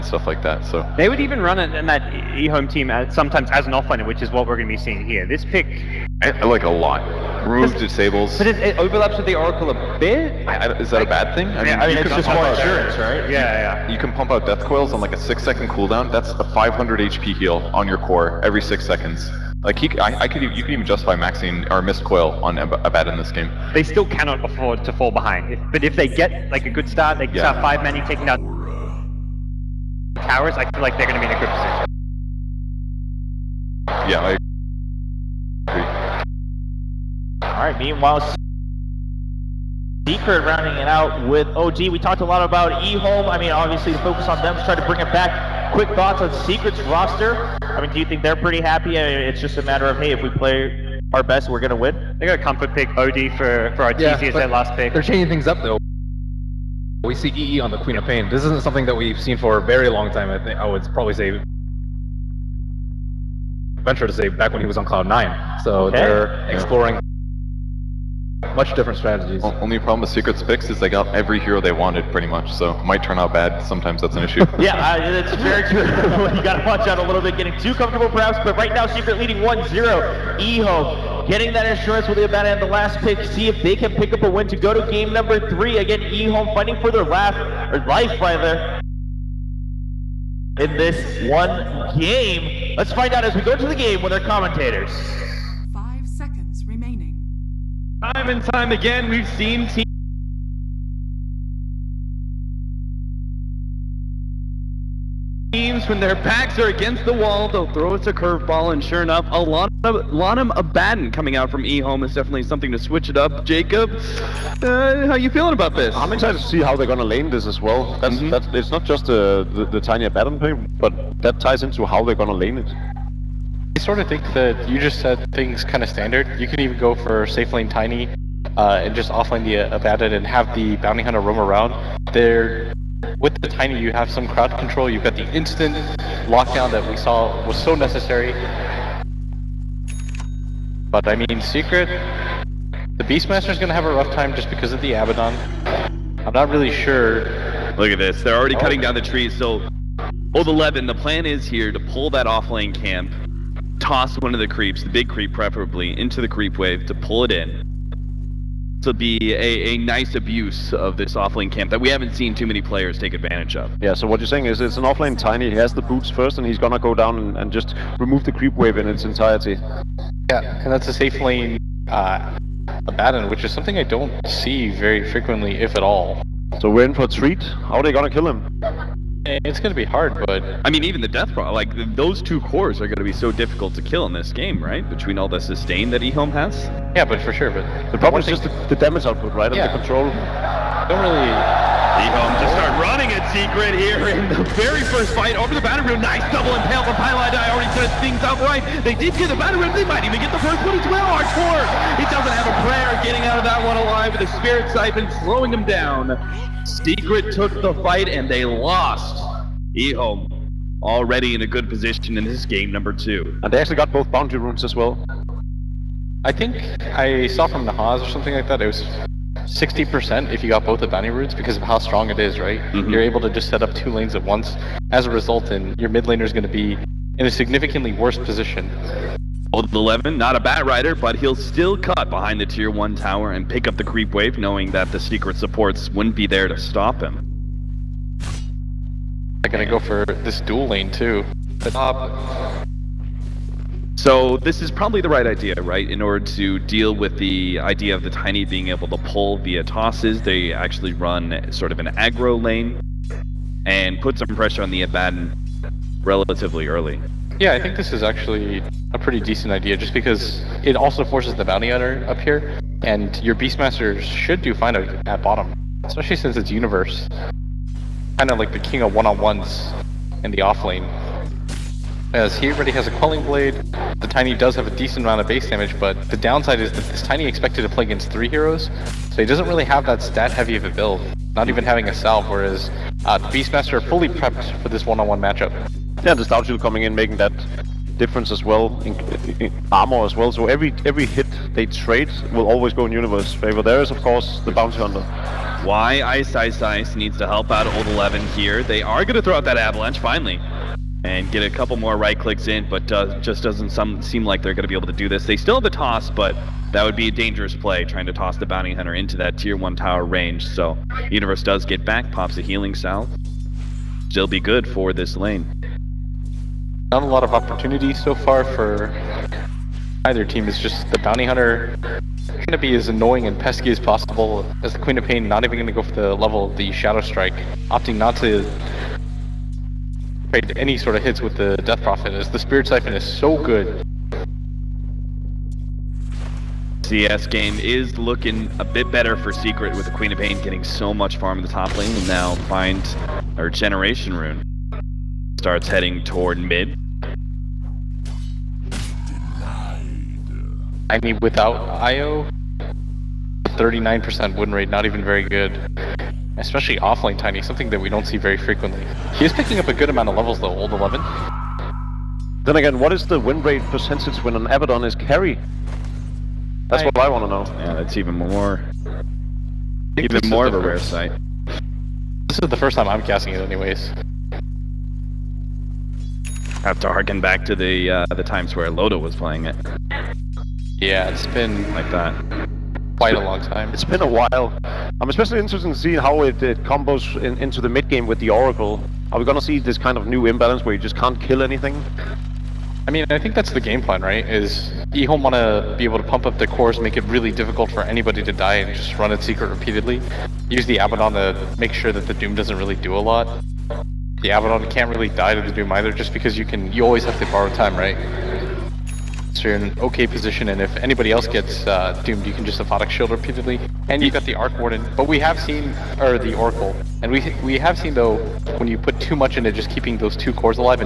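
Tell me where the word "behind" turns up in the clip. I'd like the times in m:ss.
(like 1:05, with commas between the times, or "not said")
0:25, 3:52.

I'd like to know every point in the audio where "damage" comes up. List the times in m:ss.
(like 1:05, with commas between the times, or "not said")
3:08, 4:35.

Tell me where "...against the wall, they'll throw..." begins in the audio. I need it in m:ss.
1:46.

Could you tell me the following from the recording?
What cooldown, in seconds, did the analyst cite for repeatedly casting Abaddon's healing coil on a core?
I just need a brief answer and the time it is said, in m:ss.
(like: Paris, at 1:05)
6 seconds, at 0:15.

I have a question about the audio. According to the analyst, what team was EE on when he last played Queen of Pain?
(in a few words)
Cloud Nine.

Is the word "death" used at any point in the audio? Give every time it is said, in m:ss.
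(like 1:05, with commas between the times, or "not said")
0:14, 3:01, 5:31.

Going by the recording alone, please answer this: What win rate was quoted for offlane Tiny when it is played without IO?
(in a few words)
39%.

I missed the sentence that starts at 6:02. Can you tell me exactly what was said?
Then again, what is the win rate percentage when an Abaddon is carry?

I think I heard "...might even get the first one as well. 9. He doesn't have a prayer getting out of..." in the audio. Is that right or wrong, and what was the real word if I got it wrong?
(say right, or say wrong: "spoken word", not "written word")
wrong: "4", not "9".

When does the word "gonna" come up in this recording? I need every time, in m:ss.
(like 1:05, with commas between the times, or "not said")
0:51, 2:46, 2:57.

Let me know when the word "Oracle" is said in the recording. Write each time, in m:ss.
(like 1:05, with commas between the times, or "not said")
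0:09, 6:28, 6:56.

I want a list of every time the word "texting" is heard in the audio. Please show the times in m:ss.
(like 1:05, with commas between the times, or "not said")
not said.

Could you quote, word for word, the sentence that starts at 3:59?
I'm going to go for this dual lane, too.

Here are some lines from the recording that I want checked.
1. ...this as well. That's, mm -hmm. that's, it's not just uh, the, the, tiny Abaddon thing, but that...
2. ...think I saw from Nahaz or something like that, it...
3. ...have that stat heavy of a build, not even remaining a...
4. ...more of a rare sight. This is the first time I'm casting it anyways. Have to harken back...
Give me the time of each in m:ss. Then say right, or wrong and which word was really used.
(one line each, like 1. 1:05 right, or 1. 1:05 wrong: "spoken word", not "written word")
1. 1:57 right
2. 3:36 right
3. 4:39 wrong: "having", not "remaining"
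4. 6:10 right.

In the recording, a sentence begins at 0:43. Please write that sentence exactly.
I mean, obviously, the focus on them to try to bring it back.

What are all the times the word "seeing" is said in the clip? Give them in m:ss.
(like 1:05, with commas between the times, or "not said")
0:04, 6:25.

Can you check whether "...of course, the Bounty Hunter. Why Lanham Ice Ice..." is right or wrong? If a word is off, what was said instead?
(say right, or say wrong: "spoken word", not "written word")
wrong: "Ice", not "Lanham".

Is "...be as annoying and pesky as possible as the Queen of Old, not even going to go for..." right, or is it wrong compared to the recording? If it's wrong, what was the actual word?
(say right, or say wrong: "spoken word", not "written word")
wrong: "Pain", not "Old".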